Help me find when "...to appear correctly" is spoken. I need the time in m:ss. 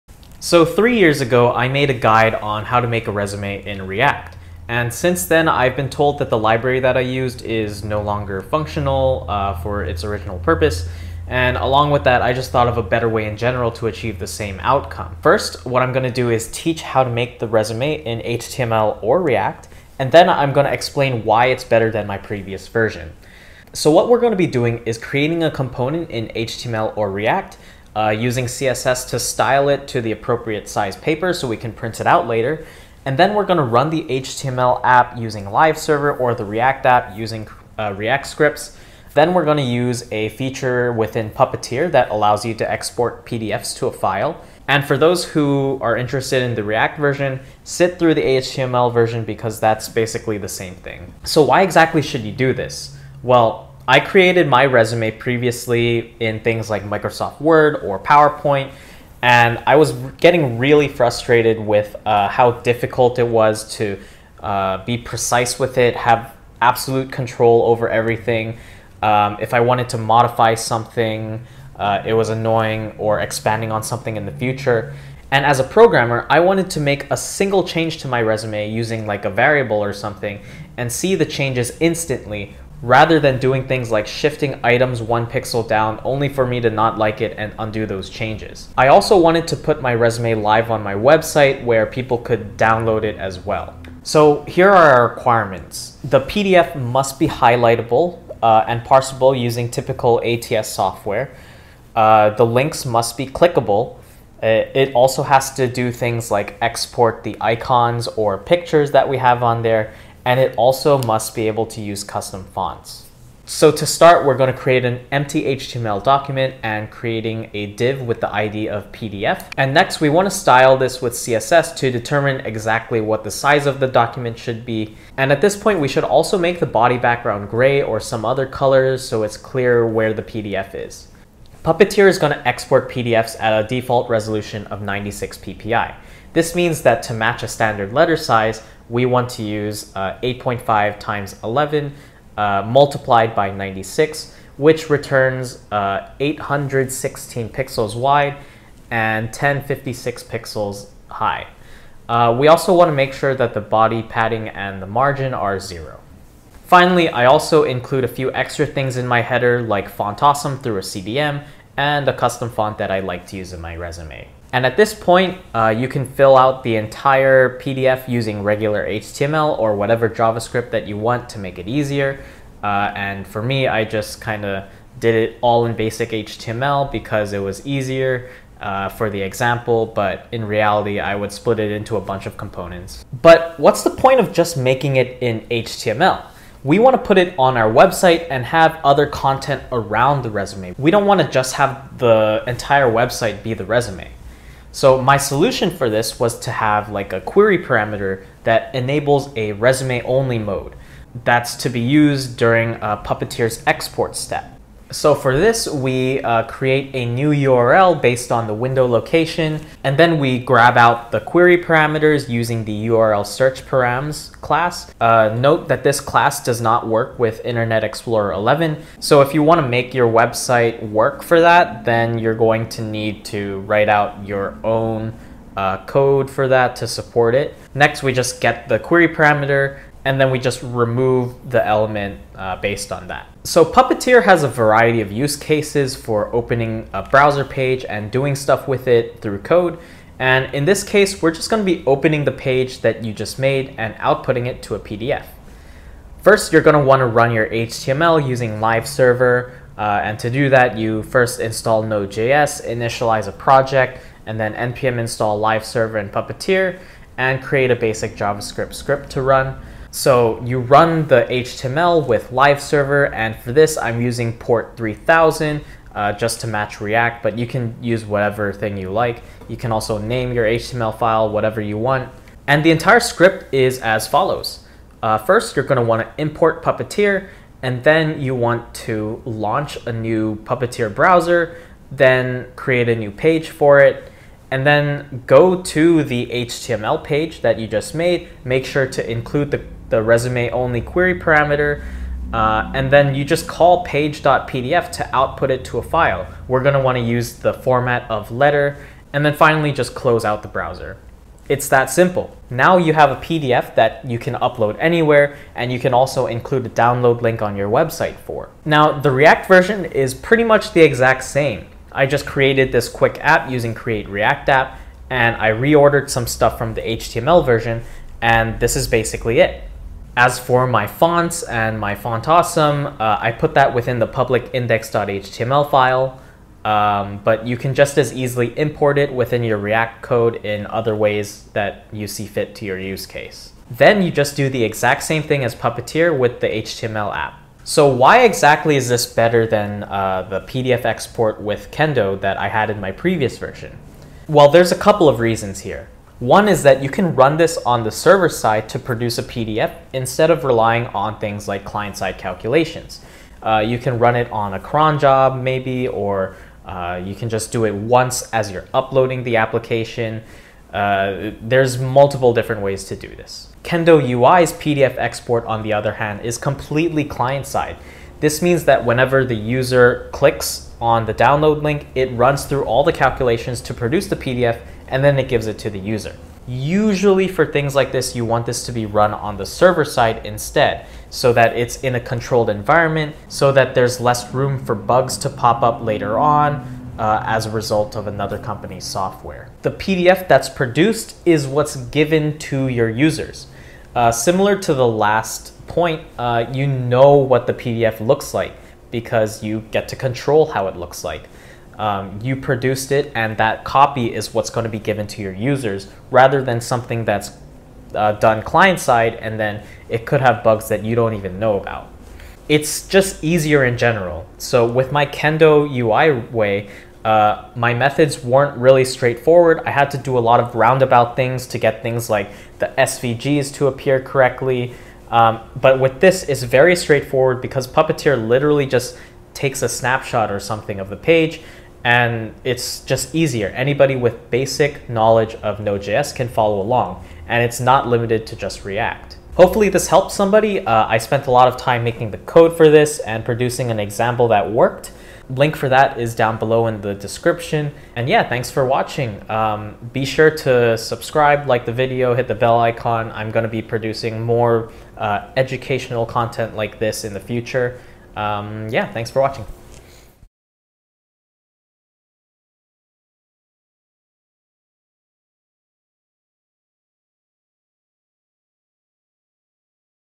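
7:03.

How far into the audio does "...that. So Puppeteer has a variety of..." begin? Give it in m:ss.
3:53.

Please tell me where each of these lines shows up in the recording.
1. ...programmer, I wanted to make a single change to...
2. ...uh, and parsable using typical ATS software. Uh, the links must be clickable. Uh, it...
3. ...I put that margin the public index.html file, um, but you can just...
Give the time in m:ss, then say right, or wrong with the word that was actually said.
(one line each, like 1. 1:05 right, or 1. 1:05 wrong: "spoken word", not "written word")
1. 1:15 right
2. 1:38 right
3. 5:23 wrong: "within", not "margin".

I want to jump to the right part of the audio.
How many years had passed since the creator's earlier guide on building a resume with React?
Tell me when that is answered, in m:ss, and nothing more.
0:00.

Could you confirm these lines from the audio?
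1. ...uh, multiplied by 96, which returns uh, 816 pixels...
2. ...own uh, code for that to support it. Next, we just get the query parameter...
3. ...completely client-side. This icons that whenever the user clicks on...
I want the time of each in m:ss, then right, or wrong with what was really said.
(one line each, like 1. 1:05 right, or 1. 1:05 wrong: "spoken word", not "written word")
1. 2:22 right
2. 3:44 right
3. 6:06 wrong: "means", not "icons".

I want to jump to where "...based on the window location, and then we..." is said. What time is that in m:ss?
3:28.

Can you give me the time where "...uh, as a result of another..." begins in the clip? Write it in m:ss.
6:26.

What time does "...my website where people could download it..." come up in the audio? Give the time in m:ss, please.
1:30.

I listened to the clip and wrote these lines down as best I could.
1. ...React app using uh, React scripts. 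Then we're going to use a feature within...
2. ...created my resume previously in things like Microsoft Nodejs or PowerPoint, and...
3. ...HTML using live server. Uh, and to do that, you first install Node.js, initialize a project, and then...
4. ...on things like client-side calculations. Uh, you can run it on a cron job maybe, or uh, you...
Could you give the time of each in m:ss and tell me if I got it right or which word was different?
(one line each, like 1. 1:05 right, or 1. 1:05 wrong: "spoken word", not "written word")
1. 0:36 right
2. 0:53 wrong: "Word", not "Nodejs"
3. 4:07 right
4. 5:50 right.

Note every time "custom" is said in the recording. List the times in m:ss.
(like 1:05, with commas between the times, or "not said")
1:52, 2:42.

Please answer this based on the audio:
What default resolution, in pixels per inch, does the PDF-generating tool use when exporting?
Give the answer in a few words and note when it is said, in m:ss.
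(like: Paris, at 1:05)
96 ppi, at 2:14.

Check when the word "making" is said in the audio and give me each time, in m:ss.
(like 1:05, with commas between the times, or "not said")
3:04, 7:21.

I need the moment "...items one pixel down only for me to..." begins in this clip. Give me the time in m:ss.
1:24.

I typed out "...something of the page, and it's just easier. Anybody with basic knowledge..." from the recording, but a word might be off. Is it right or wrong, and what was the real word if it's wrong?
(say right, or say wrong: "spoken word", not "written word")
right.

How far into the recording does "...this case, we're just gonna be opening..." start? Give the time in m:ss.
4:00.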